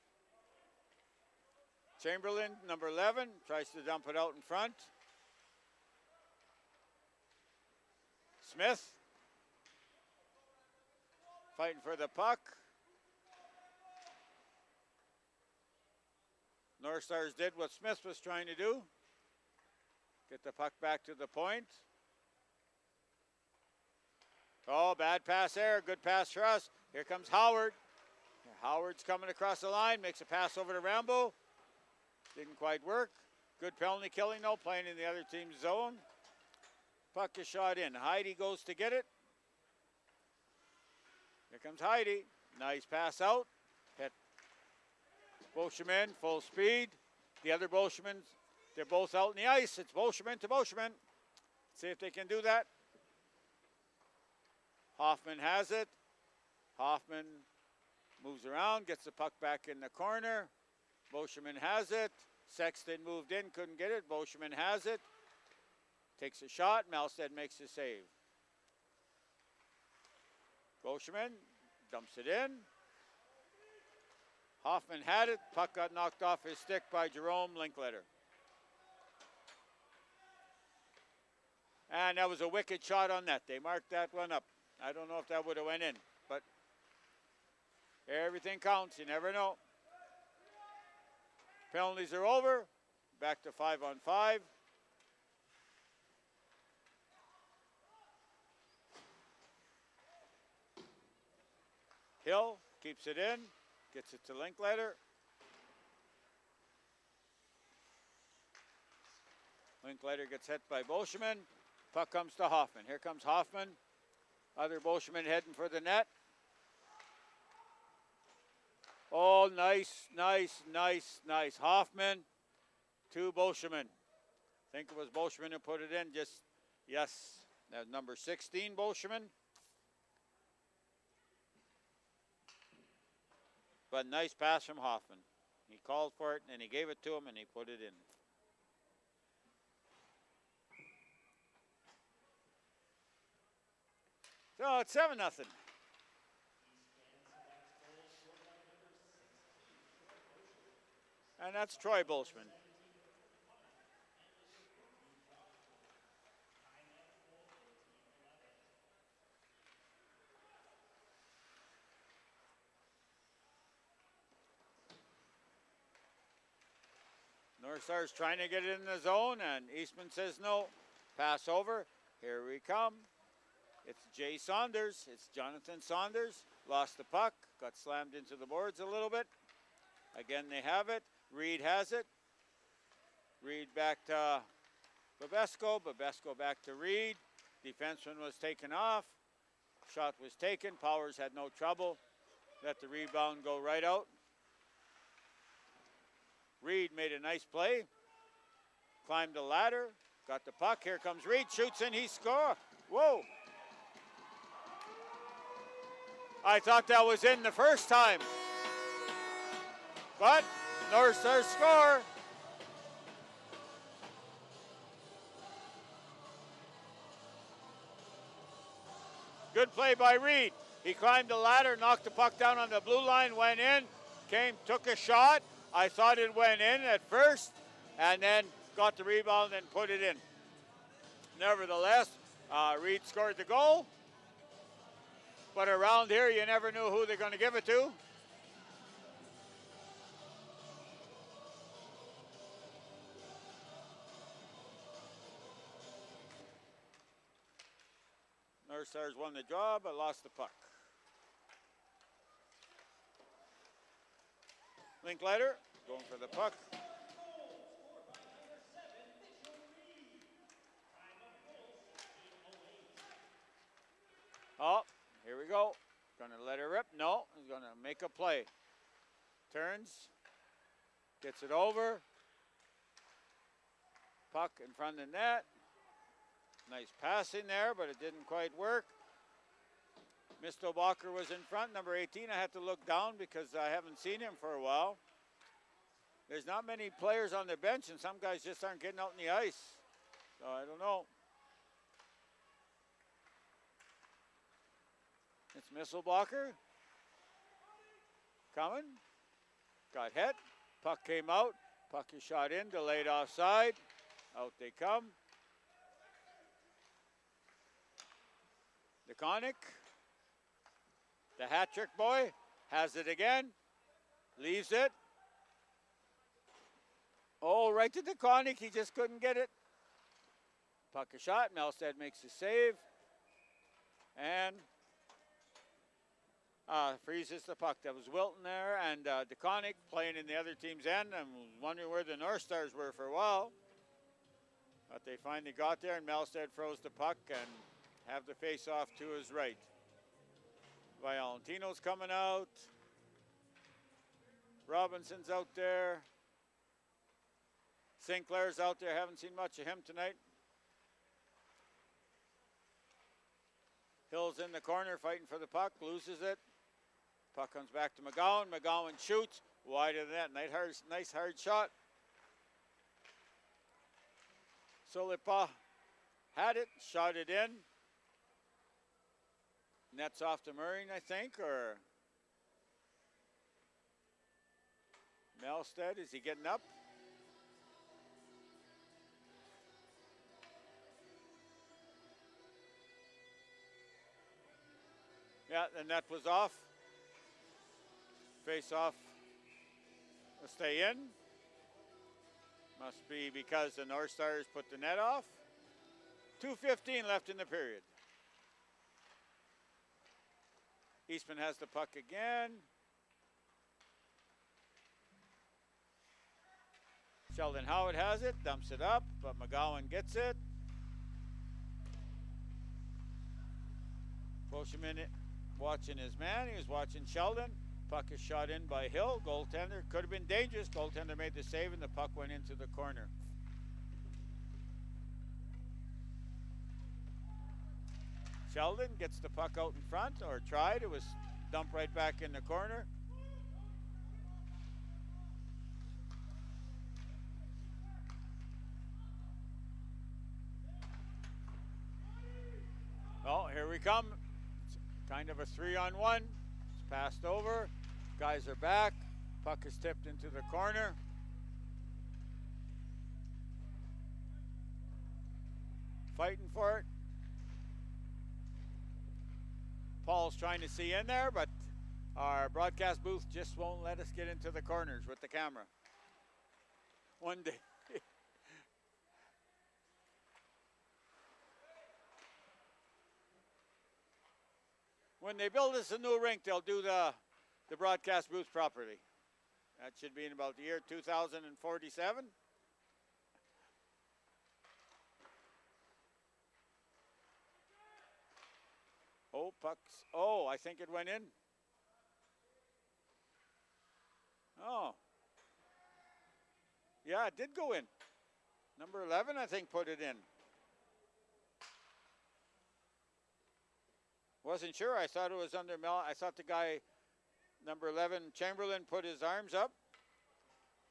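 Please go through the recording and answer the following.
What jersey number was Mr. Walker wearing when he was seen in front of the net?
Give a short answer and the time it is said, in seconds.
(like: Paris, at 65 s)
18, at 281 s.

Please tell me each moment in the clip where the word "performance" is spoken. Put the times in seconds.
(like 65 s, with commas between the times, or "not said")
not said.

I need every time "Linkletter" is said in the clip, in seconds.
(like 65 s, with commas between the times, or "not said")
77 s, 104 s, 109 s, 255 s.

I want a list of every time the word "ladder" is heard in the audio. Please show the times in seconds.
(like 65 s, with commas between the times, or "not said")
199 s, 221 s.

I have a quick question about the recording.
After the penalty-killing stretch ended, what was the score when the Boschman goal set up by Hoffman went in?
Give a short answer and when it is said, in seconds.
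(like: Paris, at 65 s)
7-0, at 144 s.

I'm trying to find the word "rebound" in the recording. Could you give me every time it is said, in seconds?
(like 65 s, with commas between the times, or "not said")
192 s, 229 s.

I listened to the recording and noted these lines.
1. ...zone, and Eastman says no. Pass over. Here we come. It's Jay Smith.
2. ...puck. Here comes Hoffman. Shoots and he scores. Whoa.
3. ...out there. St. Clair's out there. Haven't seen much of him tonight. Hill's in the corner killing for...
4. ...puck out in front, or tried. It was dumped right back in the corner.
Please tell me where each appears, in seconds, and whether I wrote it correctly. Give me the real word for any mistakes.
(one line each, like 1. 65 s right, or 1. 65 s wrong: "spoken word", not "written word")
1. 169 s wrong: "Saunders", not "Smith"
2. 200 s wrong: "Reed", not "Hoffman"
3. 345 s wrong: "fighting", not "killing"
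4. 429 s right.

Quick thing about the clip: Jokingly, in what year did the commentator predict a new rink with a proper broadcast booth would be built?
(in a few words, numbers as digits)
2047.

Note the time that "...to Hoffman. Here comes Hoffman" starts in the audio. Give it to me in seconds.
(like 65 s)
112 s.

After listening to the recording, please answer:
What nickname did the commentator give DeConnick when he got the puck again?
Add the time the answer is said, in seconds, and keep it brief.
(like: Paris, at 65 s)
the hat trick boy, at 311 s.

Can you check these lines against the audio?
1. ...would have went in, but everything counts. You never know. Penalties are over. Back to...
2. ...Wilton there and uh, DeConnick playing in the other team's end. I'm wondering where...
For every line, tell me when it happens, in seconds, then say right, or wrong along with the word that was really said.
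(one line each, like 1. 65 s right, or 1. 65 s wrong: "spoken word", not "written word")
1. 85 s right
2. 328 s right.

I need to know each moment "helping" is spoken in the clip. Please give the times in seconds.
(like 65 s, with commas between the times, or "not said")
not said.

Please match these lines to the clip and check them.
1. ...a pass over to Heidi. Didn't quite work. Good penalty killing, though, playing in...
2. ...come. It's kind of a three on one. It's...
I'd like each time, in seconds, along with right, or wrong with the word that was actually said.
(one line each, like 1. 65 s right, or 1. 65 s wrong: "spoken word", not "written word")
1. 30 s wrong: "Rambo", not "Heidi"
2. 443 s right.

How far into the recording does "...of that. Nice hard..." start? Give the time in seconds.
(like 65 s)
359 s.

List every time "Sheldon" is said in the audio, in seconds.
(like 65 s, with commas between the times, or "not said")
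407 s, 417 s, 428 s.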